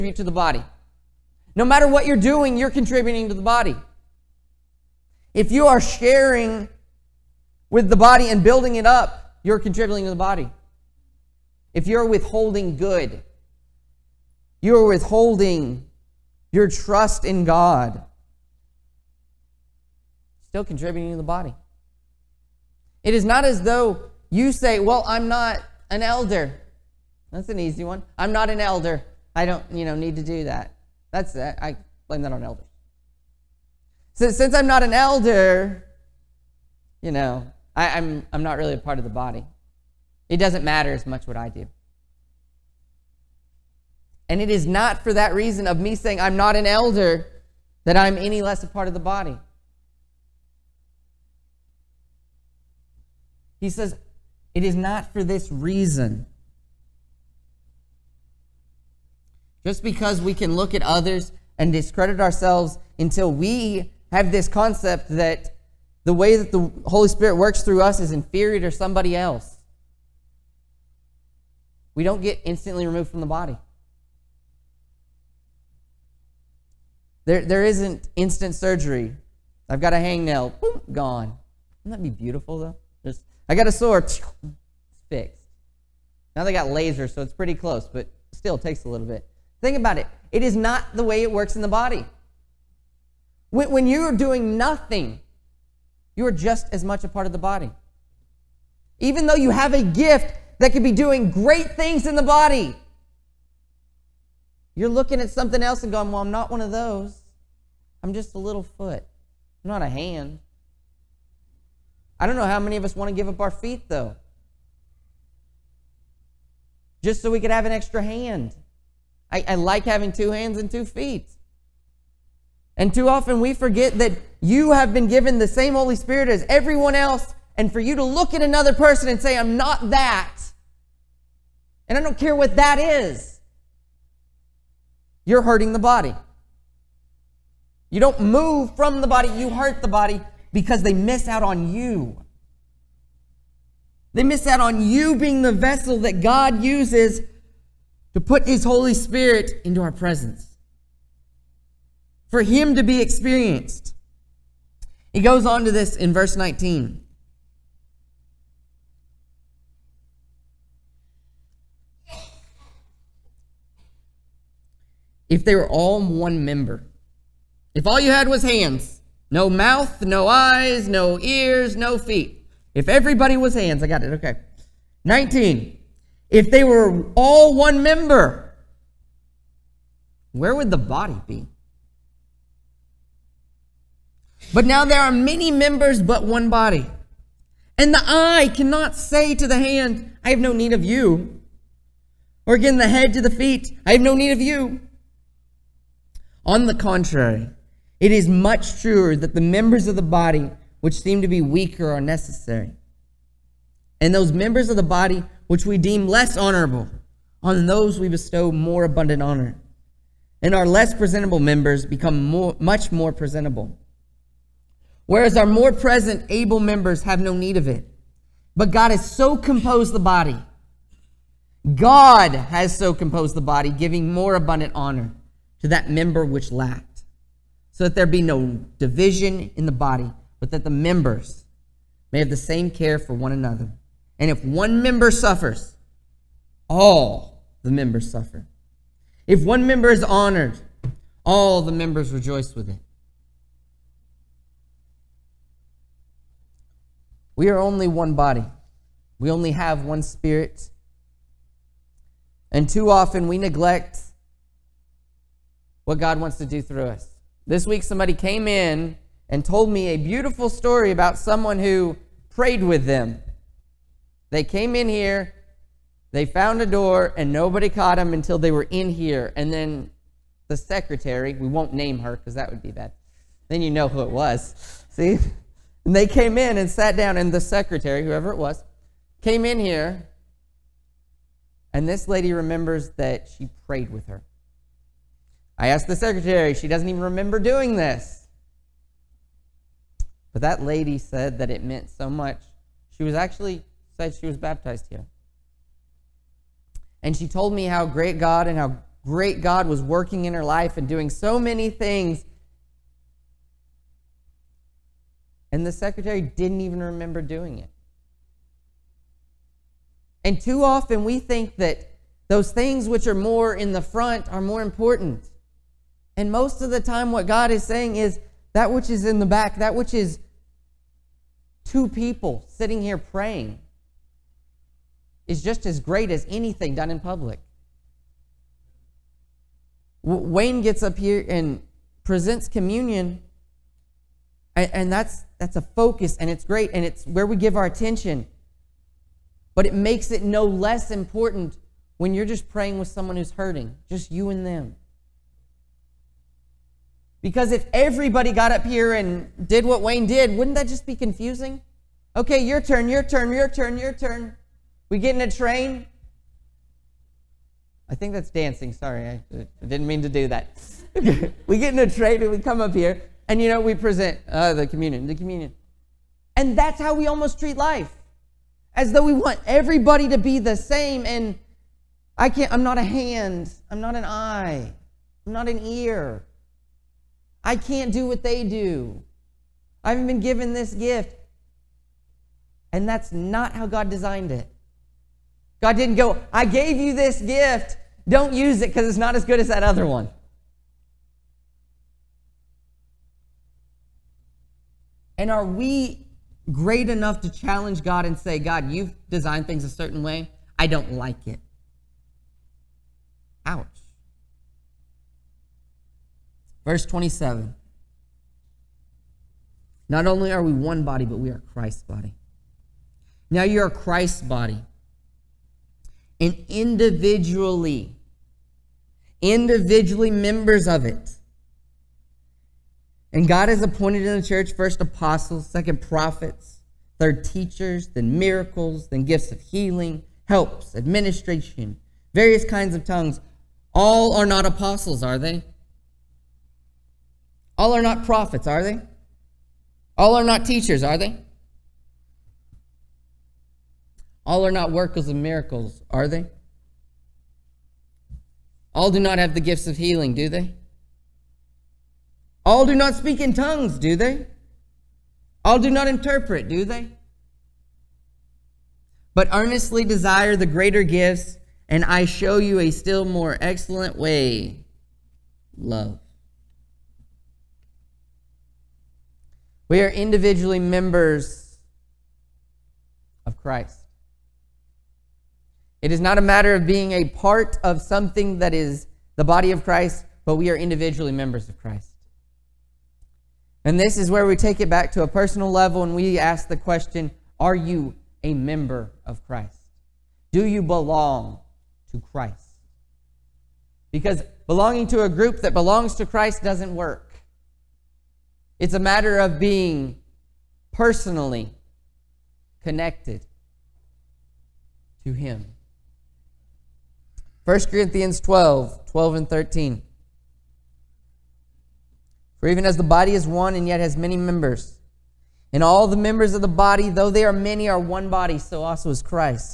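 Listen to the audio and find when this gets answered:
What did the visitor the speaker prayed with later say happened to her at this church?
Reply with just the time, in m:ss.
4:54.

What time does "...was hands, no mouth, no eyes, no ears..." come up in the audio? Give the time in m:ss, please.
2:48.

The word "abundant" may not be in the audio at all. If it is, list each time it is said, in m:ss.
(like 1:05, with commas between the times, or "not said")
3:28, 3:44.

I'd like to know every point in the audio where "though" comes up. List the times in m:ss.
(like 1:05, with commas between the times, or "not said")
0:23, 1:22, 1:39, 1:53, 6:08, 8:36.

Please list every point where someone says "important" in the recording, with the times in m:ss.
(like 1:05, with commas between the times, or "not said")
5:14, 5:40.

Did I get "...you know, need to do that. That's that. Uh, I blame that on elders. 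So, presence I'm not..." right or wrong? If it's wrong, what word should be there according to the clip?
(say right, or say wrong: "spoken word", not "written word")
wrong: "since", not "presence".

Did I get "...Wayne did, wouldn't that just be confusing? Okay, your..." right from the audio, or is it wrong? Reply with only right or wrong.
right.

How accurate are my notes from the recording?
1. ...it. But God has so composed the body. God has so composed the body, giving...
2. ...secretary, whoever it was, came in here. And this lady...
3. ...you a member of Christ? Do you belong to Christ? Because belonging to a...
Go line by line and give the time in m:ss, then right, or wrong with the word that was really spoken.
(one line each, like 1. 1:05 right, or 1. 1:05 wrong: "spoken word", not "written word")
1. 3:37 right
2. 4:37 right
3. 8:07 right.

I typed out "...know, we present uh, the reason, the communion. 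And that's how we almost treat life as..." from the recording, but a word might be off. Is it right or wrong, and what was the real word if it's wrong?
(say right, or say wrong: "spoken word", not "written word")
wrong: "communion", not "reason".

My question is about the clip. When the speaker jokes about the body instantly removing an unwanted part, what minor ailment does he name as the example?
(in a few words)
Hangnail.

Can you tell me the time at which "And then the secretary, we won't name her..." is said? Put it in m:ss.
4:29.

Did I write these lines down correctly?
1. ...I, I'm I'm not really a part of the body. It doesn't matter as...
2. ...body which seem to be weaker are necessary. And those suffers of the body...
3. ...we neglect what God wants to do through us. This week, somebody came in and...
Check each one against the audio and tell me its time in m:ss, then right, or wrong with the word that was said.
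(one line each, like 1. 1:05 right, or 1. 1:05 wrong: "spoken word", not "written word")
1. 0:37 right
2. 3:20 wrong: "members", not "suffers"
3. 4:13 right.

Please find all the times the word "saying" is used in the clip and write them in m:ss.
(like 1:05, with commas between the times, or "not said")
0:45, 5:17.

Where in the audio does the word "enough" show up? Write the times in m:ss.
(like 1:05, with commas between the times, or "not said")
6:36.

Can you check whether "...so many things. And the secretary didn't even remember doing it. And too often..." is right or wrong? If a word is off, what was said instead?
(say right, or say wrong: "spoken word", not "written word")
right.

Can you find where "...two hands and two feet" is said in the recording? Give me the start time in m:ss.
2:00.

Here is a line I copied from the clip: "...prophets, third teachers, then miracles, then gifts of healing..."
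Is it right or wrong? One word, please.
right.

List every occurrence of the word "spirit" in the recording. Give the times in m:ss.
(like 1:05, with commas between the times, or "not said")
1:07, 2:05, 2:28, 4:10.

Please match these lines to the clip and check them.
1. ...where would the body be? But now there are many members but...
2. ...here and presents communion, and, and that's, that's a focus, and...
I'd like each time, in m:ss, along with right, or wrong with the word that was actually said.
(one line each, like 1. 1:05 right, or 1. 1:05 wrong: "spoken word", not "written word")
1. 3:00 right
2. 5:30 right.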